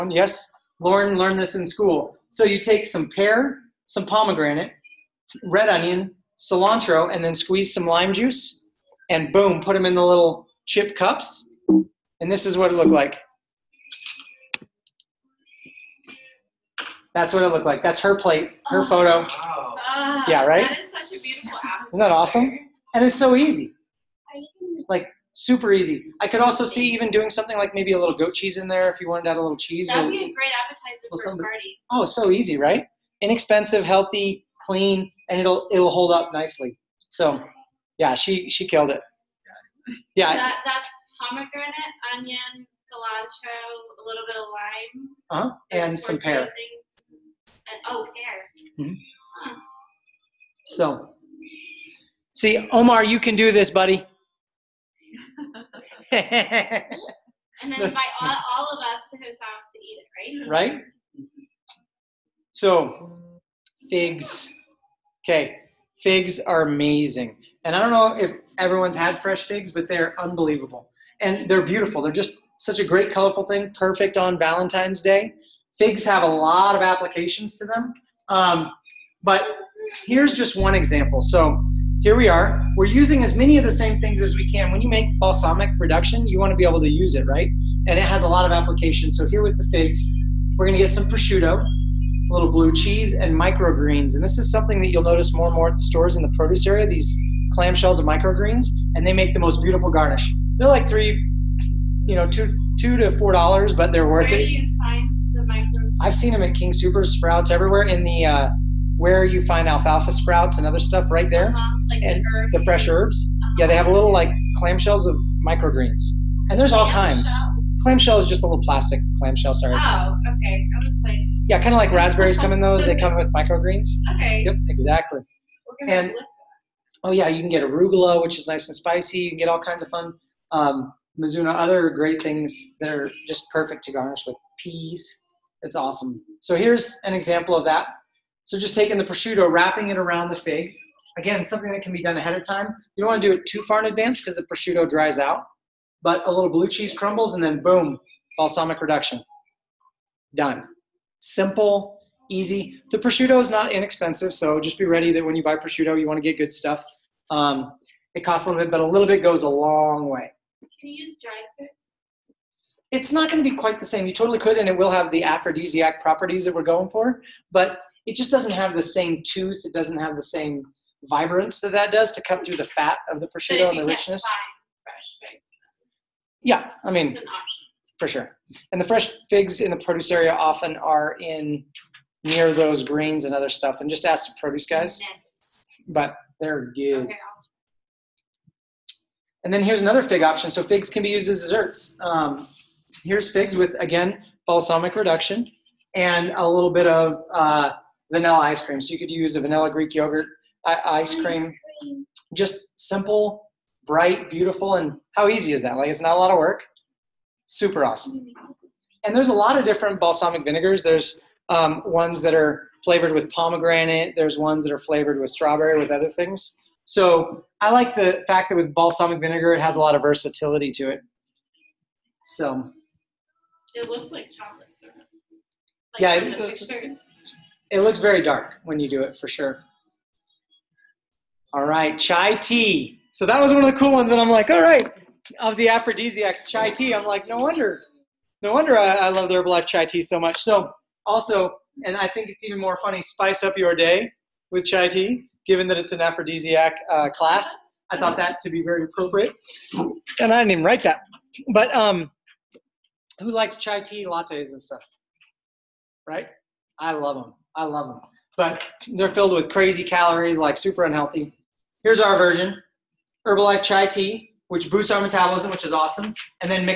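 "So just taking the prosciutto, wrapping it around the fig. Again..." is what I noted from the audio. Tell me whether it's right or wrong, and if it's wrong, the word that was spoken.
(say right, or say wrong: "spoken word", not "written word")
right.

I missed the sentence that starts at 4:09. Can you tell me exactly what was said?
And I didn't even write that.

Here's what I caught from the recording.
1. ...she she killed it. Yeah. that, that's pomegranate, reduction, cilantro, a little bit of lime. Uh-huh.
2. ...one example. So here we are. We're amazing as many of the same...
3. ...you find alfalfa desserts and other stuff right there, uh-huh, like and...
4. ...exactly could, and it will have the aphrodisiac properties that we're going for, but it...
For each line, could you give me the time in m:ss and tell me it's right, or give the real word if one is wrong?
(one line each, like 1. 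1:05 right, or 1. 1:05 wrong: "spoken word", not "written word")
1. 0:38 wrong: "onion", not "reduction"
2. 1:20 wrong: "using", not "amazing"
3. 1:49 wrong: "sprouts", not "desserts"
4. 2:44 wrong: "totally", not "exactly".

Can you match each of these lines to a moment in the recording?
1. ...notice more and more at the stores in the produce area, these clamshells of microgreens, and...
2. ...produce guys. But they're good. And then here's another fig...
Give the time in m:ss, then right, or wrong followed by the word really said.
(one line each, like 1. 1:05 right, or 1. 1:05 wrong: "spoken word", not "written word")
1. 1:35 right
2. 3:04 right.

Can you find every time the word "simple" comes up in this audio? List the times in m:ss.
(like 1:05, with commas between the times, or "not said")
2:31, 3:22.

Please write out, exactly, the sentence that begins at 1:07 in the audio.
And I don't know if everyone's had fresh figs, but they're unbelievable.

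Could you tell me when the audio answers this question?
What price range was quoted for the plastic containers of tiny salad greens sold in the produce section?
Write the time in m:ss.
1:42.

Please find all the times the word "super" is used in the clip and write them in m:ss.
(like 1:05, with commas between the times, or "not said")
0:25, 3:27, 4:20.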